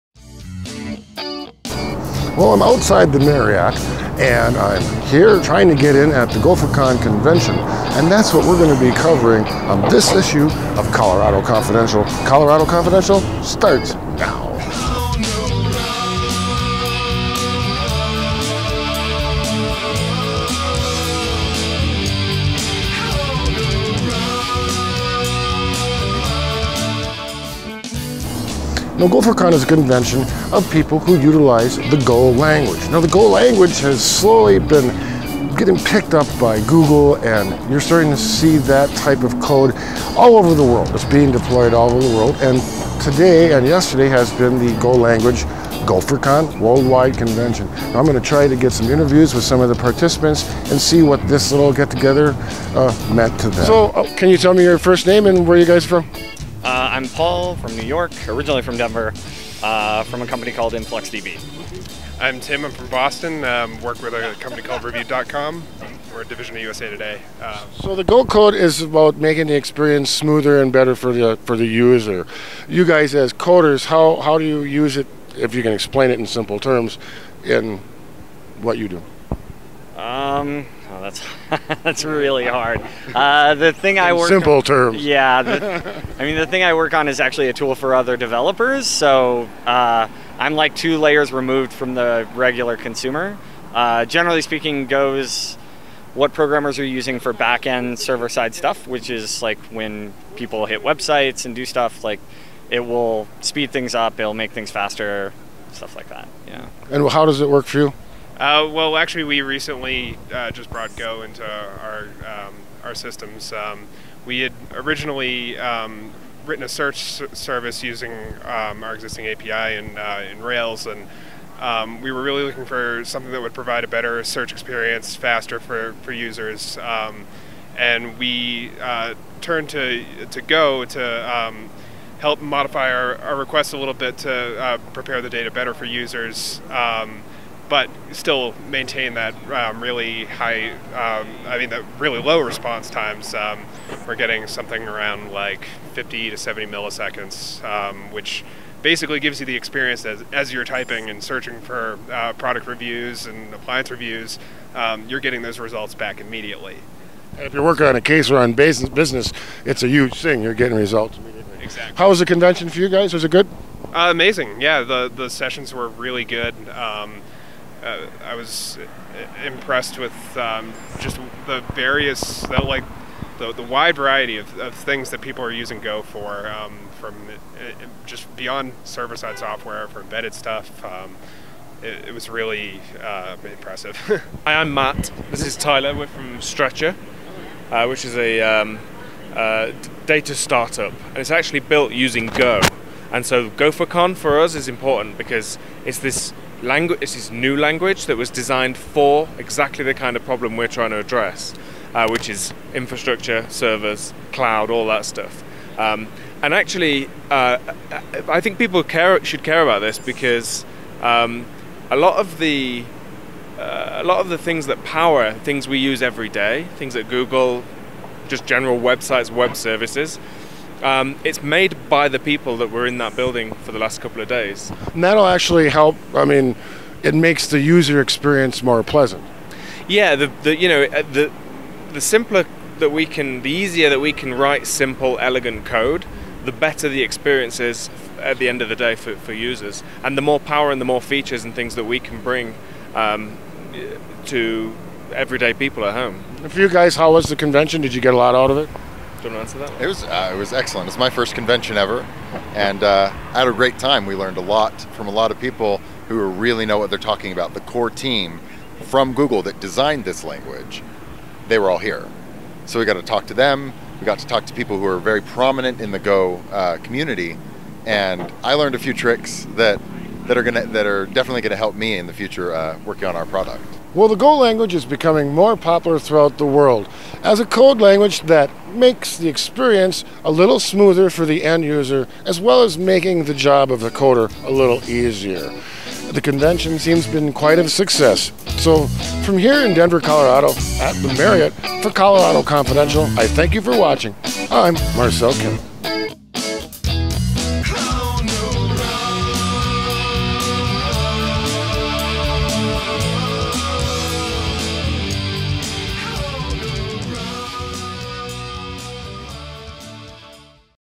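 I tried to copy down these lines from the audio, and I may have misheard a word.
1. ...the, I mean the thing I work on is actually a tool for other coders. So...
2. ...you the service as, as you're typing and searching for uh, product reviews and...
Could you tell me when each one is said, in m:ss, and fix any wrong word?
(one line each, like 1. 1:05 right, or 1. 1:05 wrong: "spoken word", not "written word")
1. 1:25 wrong: "developers", not "coders"
2. 2:29 wrong: "experience", not "service".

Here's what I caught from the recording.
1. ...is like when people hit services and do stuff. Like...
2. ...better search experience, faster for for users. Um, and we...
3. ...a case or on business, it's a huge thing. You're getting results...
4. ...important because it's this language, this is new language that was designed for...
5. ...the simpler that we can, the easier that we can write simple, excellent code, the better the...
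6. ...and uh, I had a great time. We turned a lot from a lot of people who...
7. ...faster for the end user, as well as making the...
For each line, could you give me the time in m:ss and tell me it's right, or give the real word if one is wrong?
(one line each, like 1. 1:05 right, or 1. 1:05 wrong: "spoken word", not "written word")
1. 1:39 wrong: "websites", not "services"
2. 2:03 right
3. 2:37 right
4. 3:14 right
5. 3:51 wrong: "elegant", not "excellent"
6. 4:12 wrong: "learned", not "turned"
7. 4:40 wrong: "smoother", not "faster".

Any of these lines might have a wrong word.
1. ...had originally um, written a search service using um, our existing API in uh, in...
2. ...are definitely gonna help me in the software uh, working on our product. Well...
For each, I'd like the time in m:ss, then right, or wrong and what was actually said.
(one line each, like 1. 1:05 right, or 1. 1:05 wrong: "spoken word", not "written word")
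1. 1:54 right
2. 4:30 wrong: "future", not "software".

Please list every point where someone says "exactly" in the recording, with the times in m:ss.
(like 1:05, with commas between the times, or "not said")
2:41, 3:19.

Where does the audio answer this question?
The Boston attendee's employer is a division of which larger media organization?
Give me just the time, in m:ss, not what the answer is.
1:06.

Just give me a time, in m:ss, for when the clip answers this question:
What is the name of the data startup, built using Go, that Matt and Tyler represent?
3:06.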